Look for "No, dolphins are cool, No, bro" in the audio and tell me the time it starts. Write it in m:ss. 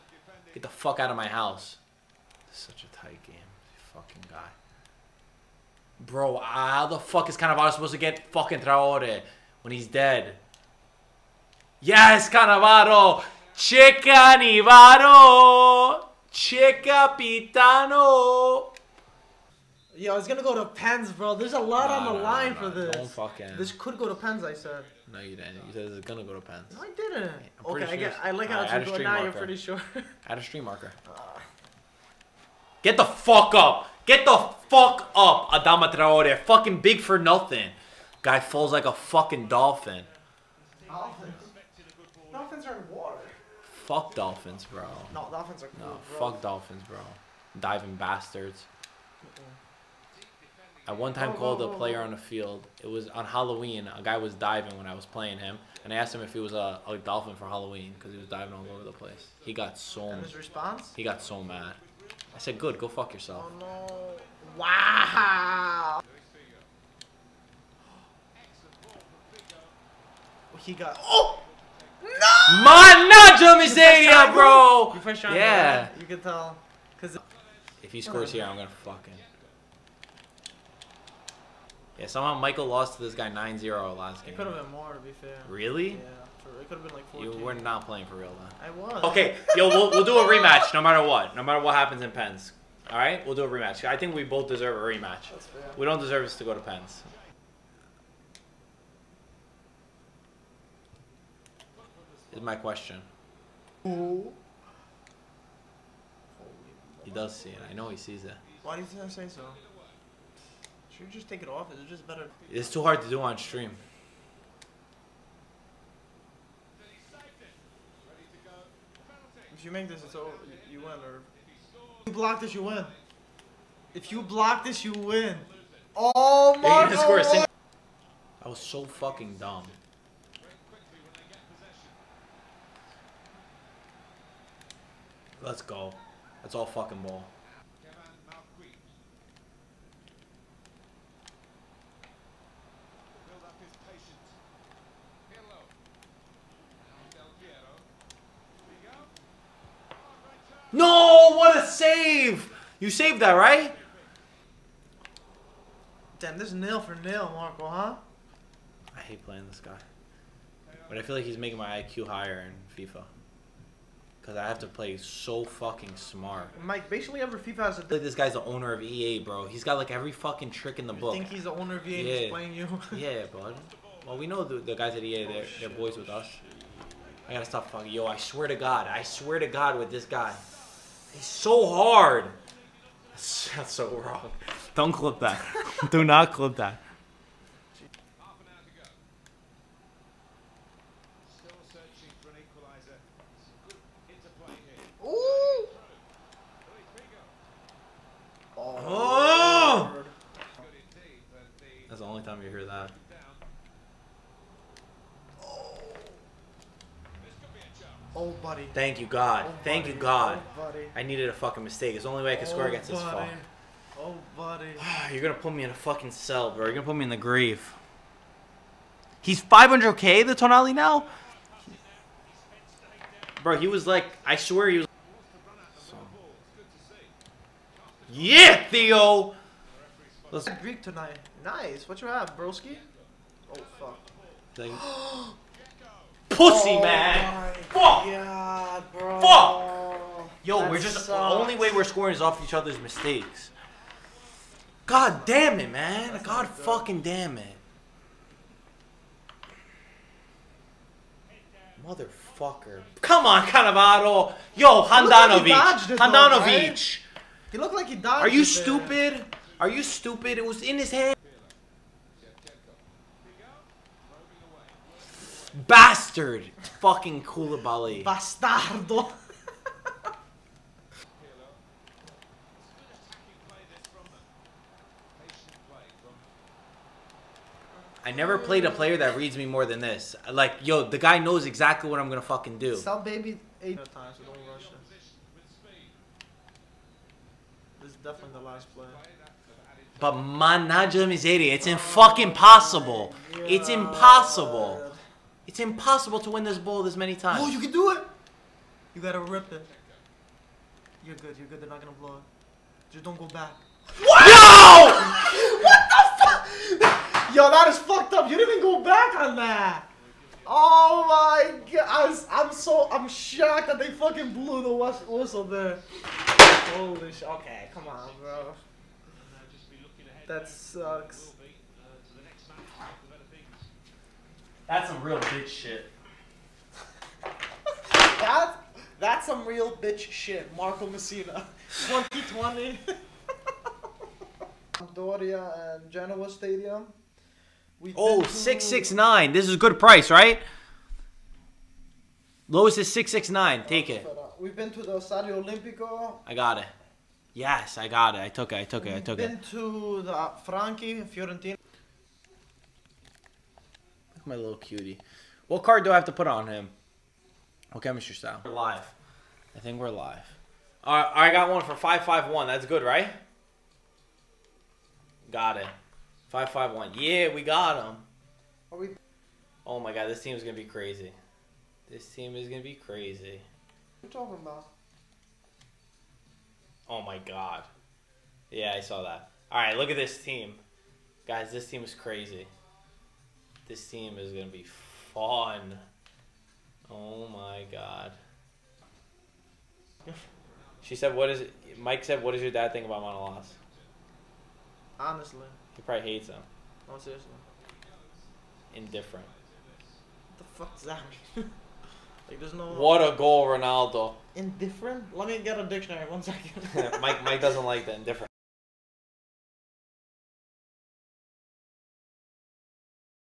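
0:45.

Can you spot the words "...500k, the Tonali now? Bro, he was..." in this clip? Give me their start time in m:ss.
3:39.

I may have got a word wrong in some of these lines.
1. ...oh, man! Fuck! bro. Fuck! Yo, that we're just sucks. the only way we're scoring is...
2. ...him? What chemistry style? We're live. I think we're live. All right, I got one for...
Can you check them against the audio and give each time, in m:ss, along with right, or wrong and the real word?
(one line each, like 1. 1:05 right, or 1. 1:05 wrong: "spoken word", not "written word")
1. 3:56 right
2. 5:56 right.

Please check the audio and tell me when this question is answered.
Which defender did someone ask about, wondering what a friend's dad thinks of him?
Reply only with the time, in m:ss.
6:33.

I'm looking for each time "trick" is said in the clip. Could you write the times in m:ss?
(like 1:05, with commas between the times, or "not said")
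2:50.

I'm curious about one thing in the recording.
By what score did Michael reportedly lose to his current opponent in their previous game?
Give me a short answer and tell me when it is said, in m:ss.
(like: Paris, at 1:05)
9-0, at 1:23.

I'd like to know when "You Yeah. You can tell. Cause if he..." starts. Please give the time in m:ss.
1:14.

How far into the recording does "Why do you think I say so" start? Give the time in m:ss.
1:48.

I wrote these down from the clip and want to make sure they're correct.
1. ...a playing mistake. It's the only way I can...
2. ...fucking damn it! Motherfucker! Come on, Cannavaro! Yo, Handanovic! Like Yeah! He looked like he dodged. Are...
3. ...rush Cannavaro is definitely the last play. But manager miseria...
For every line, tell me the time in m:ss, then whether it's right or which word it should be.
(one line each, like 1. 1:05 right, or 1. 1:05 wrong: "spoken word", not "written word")
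1. 3:31 wrong: "fucking", not "playing"
2. 4:06 wrong: "Handanovic", not "Yeah"
3. 4:44 wrong: "This", not "Cannavaro".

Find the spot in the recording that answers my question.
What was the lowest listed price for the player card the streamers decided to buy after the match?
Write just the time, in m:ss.
5:42.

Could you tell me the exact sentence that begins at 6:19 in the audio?
All right, look at this team.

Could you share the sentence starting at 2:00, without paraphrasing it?
You win, or if you block this, you win.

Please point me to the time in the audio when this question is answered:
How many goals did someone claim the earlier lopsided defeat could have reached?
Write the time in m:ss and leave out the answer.
1:27.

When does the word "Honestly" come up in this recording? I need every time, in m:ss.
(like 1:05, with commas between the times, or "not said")
6:34.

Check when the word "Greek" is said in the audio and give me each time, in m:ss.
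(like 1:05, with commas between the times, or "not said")
3:50.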